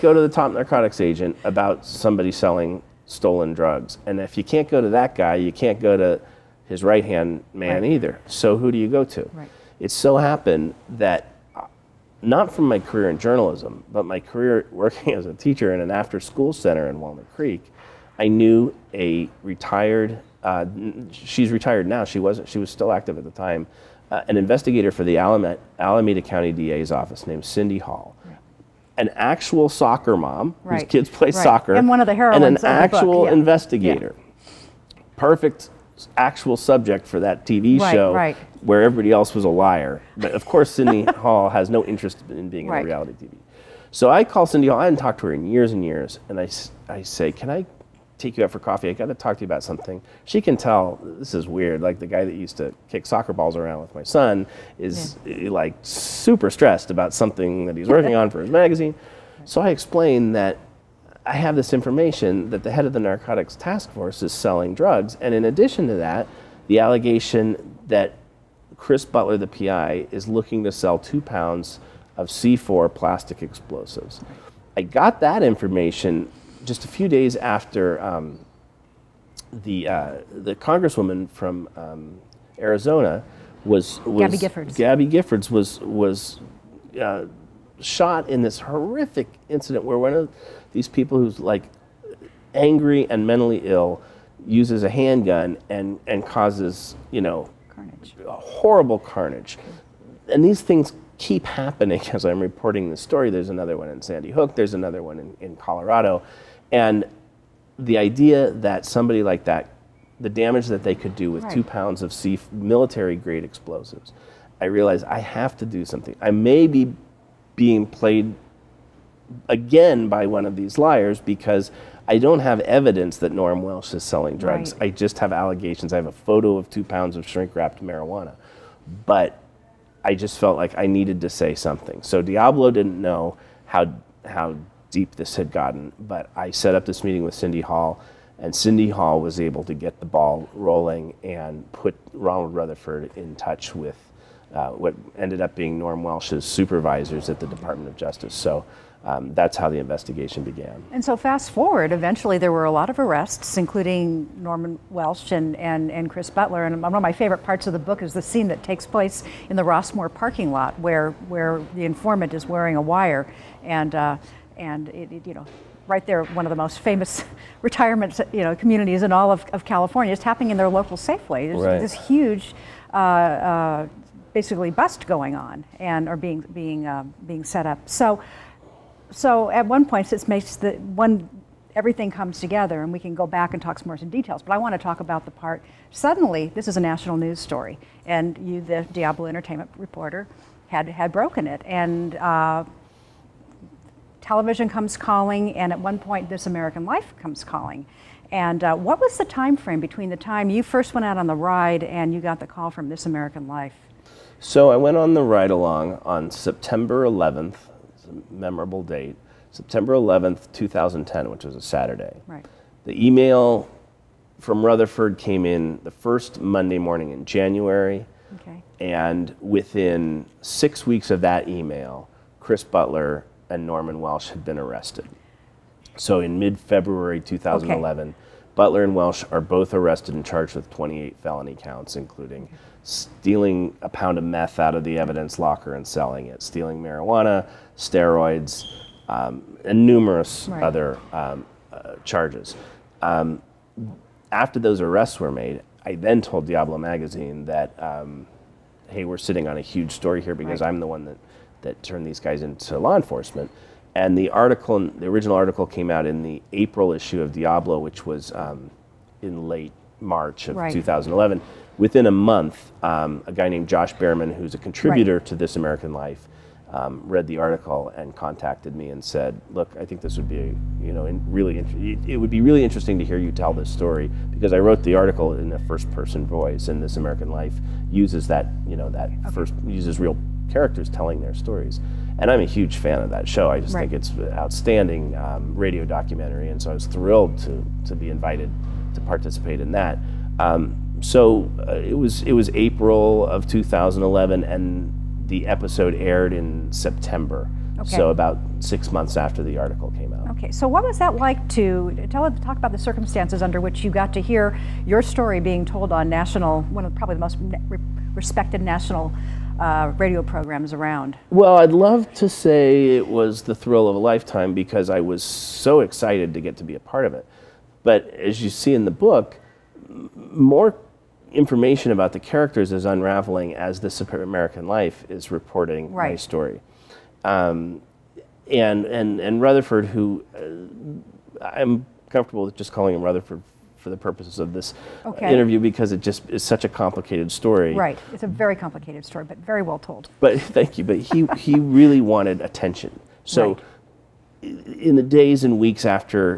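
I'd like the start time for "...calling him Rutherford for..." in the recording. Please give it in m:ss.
5:32.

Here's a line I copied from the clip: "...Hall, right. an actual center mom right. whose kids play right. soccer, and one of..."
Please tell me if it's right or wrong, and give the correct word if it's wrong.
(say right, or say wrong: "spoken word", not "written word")
wrong: "soccer", not "center".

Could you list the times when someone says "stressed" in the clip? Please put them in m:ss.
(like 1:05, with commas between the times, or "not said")
0:56.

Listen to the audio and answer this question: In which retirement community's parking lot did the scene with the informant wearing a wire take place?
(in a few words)
Rossmoor.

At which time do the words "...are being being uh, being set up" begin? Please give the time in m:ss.
2:56.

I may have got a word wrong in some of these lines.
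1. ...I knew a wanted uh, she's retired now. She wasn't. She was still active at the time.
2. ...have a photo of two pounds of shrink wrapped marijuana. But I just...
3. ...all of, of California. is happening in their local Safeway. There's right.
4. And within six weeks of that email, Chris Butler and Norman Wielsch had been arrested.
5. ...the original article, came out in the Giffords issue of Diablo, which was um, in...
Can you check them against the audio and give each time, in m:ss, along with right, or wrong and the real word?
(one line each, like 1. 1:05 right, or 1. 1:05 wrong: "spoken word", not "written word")
1. 0:18 wrong: "retired", not "wanted"
2. 2:05 right
3. 2:49 right
4. 3:38 right
5. 4:14 wrong: "April", not "Giffords".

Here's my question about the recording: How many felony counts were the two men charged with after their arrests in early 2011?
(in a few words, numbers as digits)
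28.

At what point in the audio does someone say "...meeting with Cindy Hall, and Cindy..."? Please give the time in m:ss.
2:17.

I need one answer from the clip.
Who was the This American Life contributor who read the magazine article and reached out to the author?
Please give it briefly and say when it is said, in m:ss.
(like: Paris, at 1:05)
Josh Bearman, at 4:23.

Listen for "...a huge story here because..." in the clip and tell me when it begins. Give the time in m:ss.
4:09.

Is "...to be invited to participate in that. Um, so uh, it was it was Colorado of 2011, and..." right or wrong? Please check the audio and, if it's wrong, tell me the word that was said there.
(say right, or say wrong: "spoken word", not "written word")
wrong: "April", not "Colorado".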